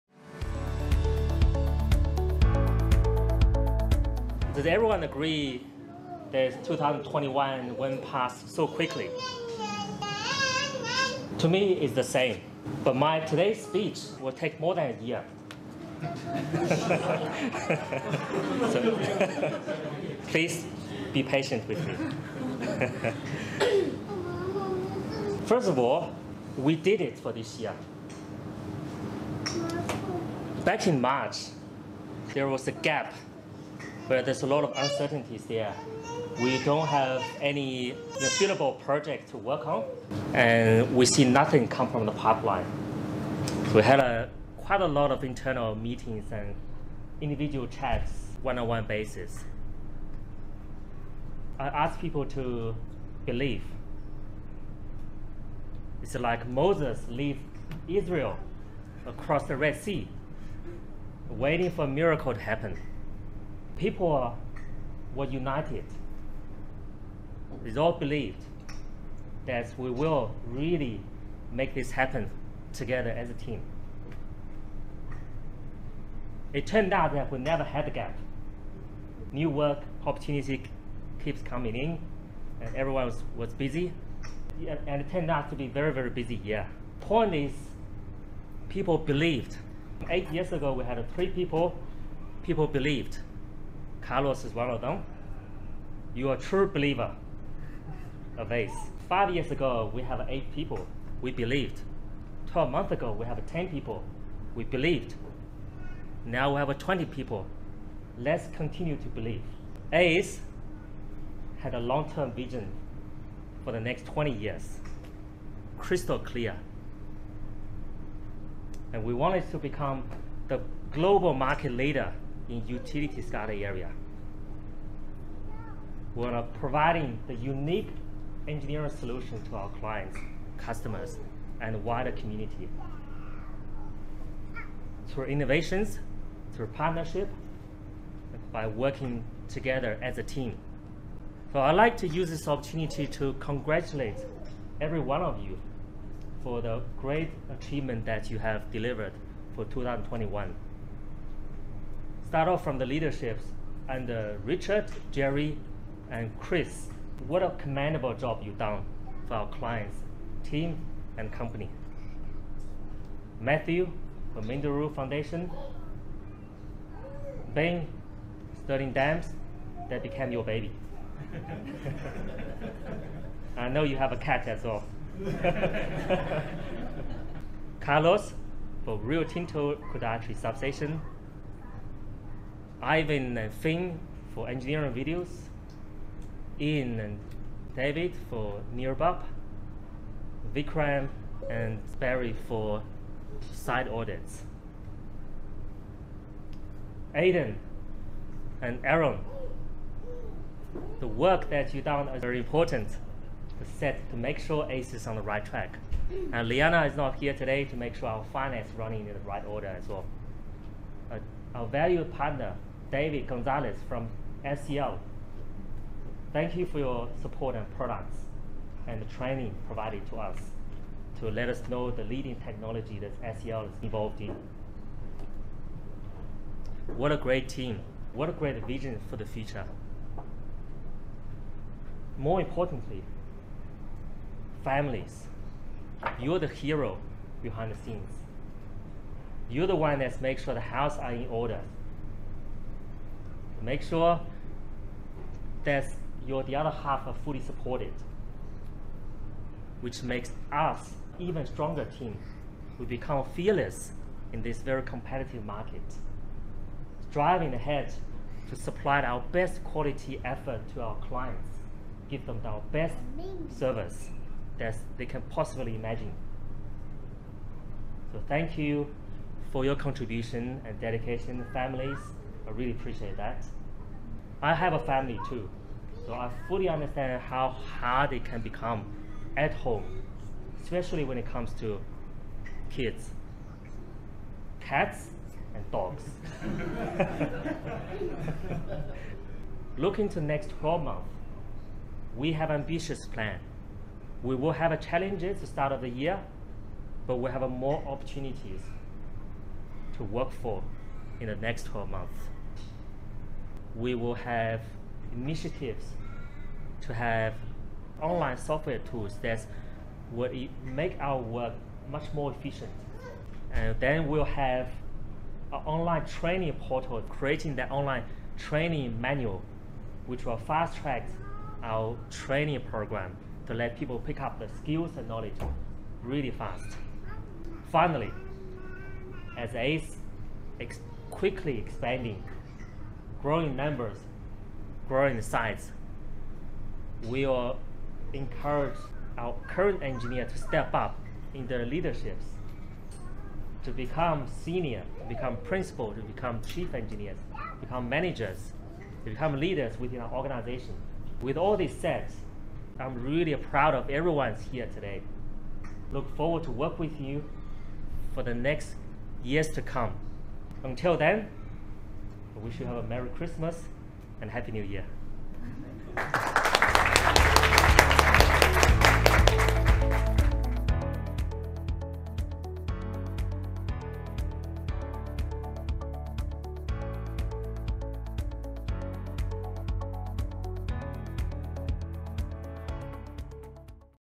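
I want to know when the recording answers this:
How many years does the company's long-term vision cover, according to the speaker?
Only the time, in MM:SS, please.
01:54.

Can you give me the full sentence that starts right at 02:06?
We're providing the unique engineering solution to our clients, customers, and wider community.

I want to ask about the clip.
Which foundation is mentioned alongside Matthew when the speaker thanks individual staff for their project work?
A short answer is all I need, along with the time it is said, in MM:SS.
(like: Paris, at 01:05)
Minderoo Foundation, at 02:44.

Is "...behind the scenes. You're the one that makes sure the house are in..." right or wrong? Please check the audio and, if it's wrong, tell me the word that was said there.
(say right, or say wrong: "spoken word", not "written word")
right.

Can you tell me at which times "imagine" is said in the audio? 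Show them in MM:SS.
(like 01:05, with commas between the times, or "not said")
04:25.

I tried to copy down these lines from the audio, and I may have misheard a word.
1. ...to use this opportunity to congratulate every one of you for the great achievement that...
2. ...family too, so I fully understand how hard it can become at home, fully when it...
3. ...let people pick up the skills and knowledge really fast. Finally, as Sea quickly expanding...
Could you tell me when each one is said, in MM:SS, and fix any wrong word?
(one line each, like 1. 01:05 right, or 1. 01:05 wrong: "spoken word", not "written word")
1. 02:21 right
2. 04:34 wrong: "especially", not "fully"
3. 05:23 wrong: "ACE", not "Sea".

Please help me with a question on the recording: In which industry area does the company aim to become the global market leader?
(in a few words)
utility SCADA.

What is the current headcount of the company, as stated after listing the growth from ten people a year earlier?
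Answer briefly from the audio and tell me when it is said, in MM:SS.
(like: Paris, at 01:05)
20, at 01:46.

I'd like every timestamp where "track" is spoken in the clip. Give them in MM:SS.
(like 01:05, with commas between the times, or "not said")
03:25, 05:20.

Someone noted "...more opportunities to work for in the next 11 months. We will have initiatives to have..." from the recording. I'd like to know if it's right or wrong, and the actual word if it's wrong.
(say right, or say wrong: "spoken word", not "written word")
wrong: "12", not "11".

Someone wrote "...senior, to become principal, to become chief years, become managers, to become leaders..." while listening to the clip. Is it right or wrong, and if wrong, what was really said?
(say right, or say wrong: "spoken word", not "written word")
wrong: "engineers", not "years".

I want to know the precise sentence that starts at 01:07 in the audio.
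They all believed that we will really make this happen together as a team.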